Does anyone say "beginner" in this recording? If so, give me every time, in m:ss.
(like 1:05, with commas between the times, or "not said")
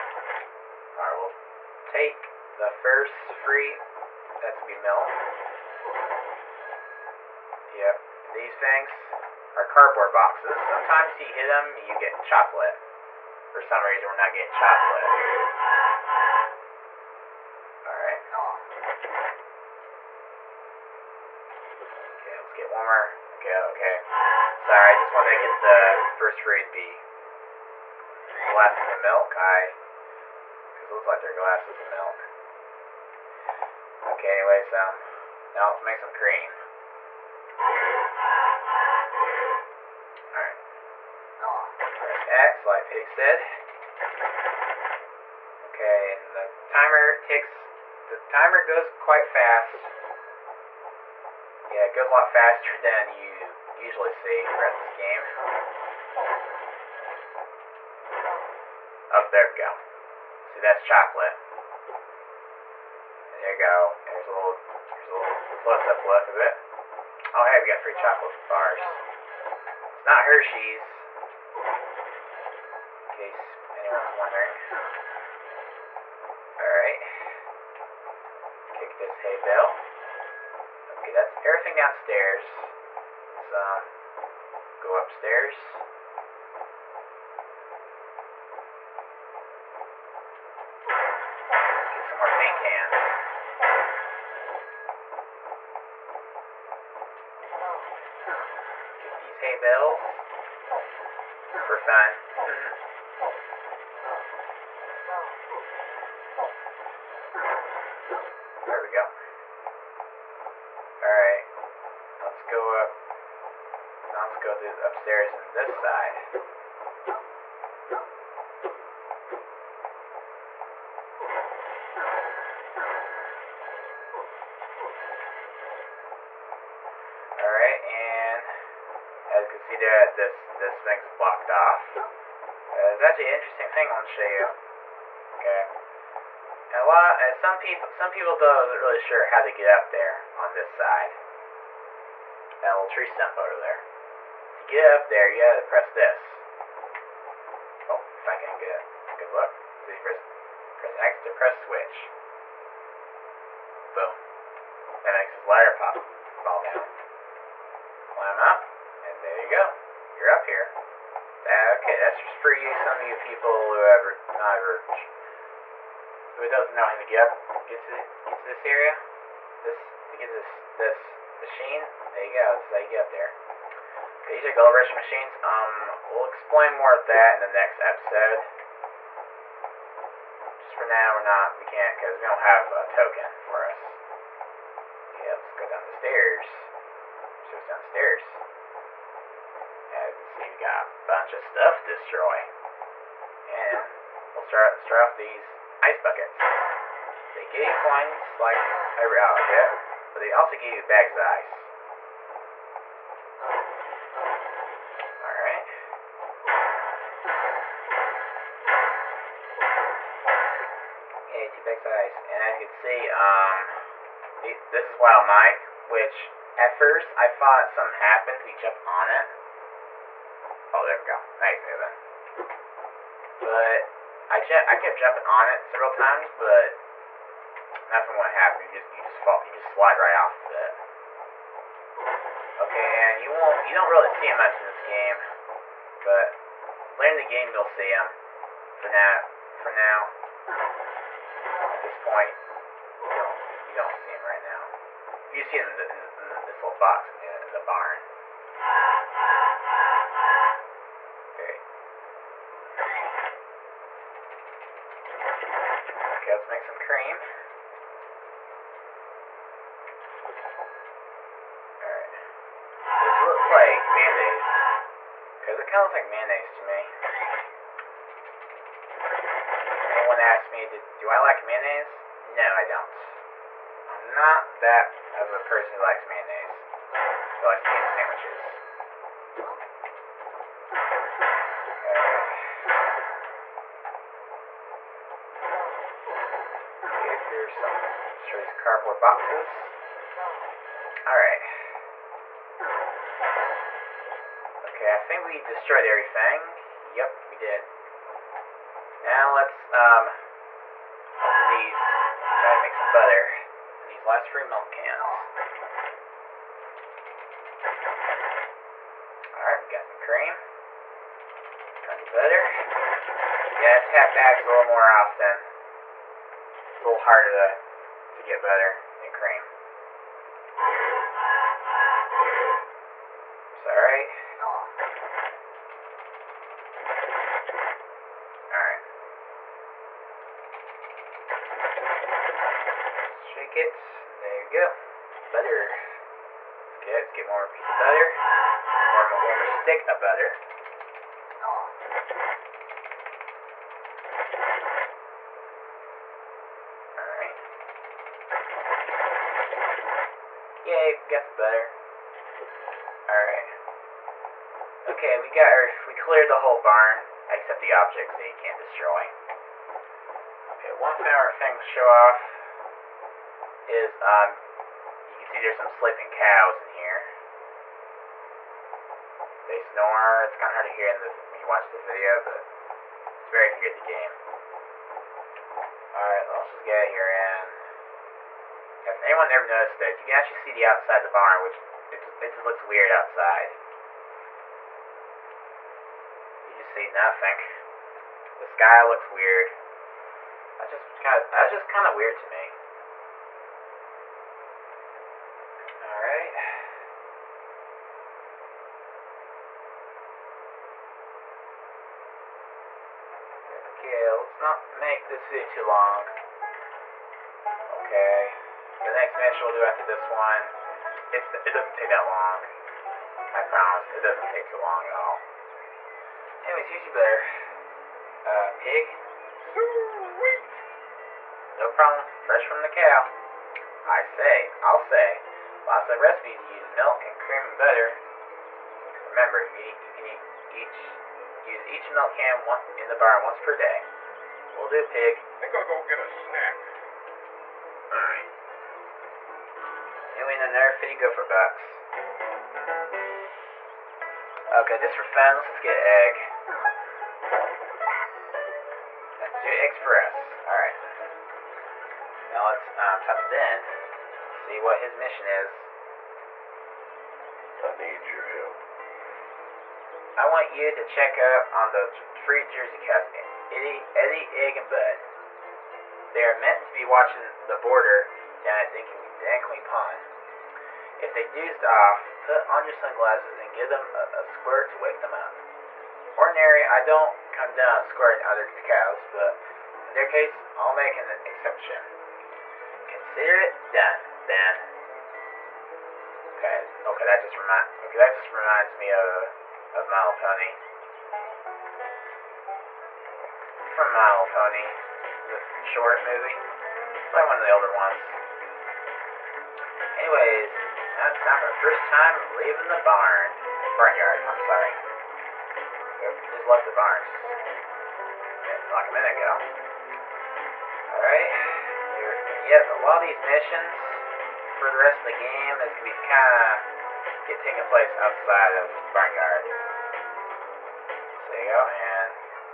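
not said.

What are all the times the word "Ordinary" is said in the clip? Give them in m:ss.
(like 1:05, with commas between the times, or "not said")
7:56.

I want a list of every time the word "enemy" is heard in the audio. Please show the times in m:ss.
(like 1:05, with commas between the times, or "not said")
not said.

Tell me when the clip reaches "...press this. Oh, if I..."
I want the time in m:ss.
2:25.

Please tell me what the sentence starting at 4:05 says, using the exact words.
You see him in, the, in, the, in the, this little box in the, in the barn.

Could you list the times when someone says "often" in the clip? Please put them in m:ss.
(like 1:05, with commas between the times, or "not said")
5:14.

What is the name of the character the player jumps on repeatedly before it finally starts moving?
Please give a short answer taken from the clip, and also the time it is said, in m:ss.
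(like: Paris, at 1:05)
Wild Mike, at 3:34.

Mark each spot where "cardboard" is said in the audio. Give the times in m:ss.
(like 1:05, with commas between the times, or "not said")
0:09, 4:48.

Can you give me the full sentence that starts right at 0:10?
Sometimes you hit them, you get chocolate.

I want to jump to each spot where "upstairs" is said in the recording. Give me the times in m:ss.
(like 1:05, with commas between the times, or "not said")
1:24, 1:54.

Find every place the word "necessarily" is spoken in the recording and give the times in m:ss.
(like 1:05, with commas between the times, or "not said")
not said.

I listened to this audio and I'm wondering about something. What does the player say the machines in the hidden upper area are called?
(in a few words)
gold rush machines.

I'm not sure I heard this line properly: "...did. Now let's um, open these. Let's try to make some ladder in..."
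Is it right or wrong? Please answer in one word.
wrong.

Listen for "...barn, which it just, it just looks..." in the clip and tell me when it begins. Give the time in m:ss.
6:21.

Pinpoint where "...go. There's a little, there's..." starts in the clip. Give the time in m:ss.
1:03.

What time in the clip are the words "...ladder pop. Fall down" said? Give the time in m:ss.
2:35.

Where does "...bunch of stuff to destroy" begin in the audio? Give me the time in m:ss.
3:11.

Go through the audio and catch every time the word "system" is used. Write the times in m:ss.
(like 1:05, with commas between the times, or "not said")
not said.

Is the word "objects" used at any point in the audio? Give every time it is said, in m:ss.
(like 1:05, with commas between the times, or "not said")
5:57.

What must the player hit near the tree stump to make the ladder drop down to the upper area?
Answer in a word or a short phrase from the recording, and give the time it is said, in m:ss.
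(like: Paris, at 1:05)
switch, at 2:31.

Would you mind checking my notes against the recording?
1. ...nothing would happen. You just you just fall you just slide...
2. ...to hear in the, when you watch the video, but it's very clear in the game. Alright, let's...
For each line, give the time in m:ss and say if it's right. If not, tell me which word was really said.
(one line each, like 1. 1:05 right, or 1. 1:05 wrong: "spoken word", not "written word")
1. 3:47 right
2. 6:10 right.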